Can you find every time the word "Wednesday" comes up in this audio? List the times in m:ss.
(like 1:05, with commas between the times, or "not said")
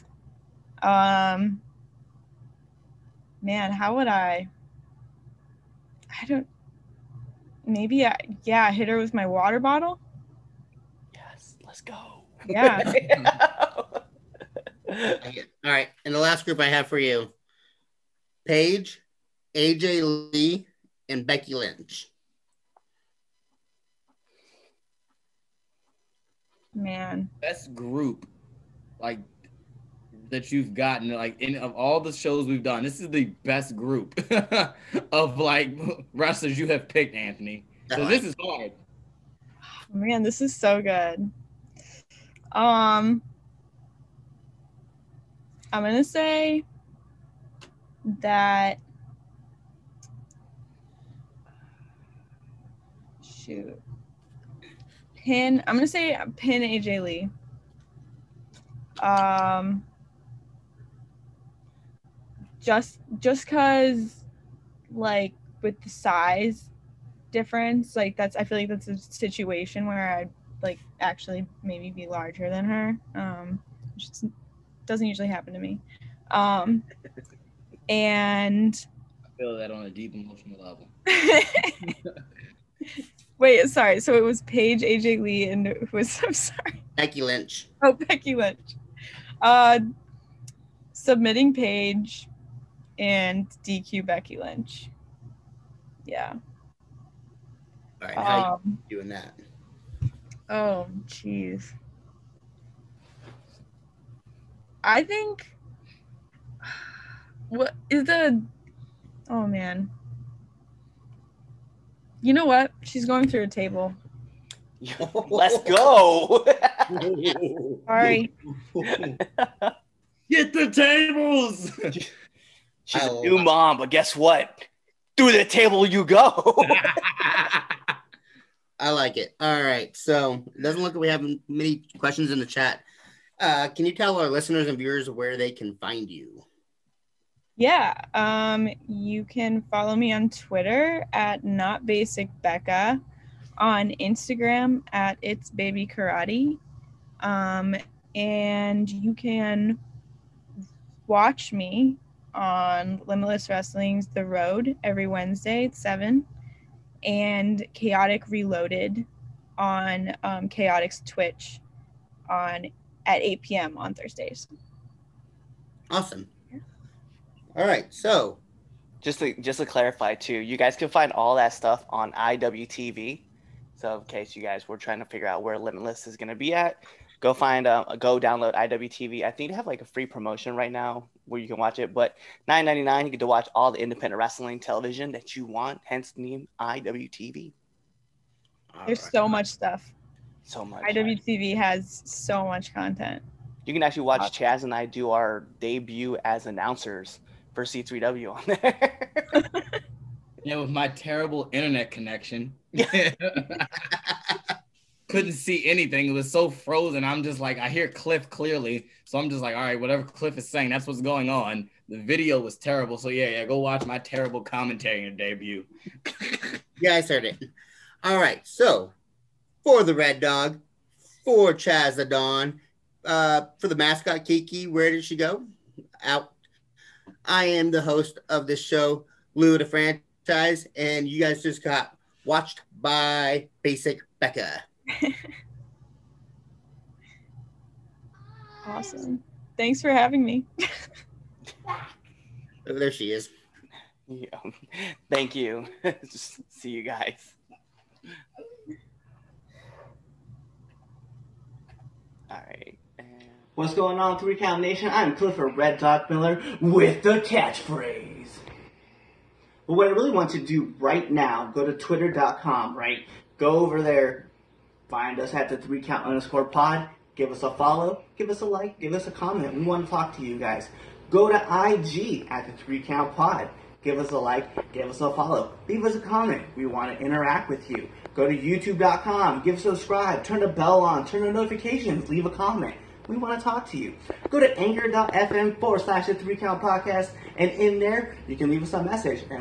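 2:35.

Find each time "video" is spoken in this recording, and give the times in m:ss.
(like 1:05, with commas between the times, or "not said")
3:31.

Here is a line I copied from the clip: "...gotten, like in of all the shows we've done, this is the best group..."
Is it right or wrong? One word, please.
right.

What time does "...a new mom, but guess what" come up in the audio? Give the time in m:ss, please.
2:03.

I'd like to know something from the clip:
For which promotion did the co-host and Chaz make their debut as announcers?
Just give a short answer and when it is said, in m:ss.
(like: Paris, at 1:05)
C3W, at 3:17.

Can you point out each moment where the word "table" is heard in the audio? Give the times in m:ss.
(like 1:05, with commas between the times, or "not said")
1:53, 2:00, 2:05.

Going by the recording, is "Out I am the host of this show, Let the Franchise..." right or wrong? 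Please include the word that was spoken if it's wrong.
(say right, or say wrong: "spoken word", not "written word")
wrong: "Lou", not "Let".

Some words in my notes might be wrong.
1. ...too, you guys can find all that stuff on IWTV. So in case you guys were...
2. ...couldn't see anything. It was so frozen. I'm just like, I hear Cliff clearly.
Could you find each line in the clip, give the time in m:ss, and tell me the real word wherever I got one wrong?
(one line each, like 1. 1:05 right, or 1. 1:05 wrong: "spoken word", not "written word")
1. 2:50 right
2. 3:25 right.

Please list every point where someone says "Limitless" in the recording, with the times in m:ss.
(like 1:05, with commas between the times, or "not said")
2:33, 2:55.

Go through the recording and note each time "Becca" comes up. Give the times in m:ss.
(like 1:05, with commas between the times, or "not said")
2:22, 3:54.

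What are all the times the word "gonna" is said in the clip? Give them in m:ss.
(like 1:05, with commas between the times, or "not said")
0:45, 0:55.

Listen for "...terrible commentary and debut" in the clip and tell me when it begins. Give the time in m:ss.
3:33.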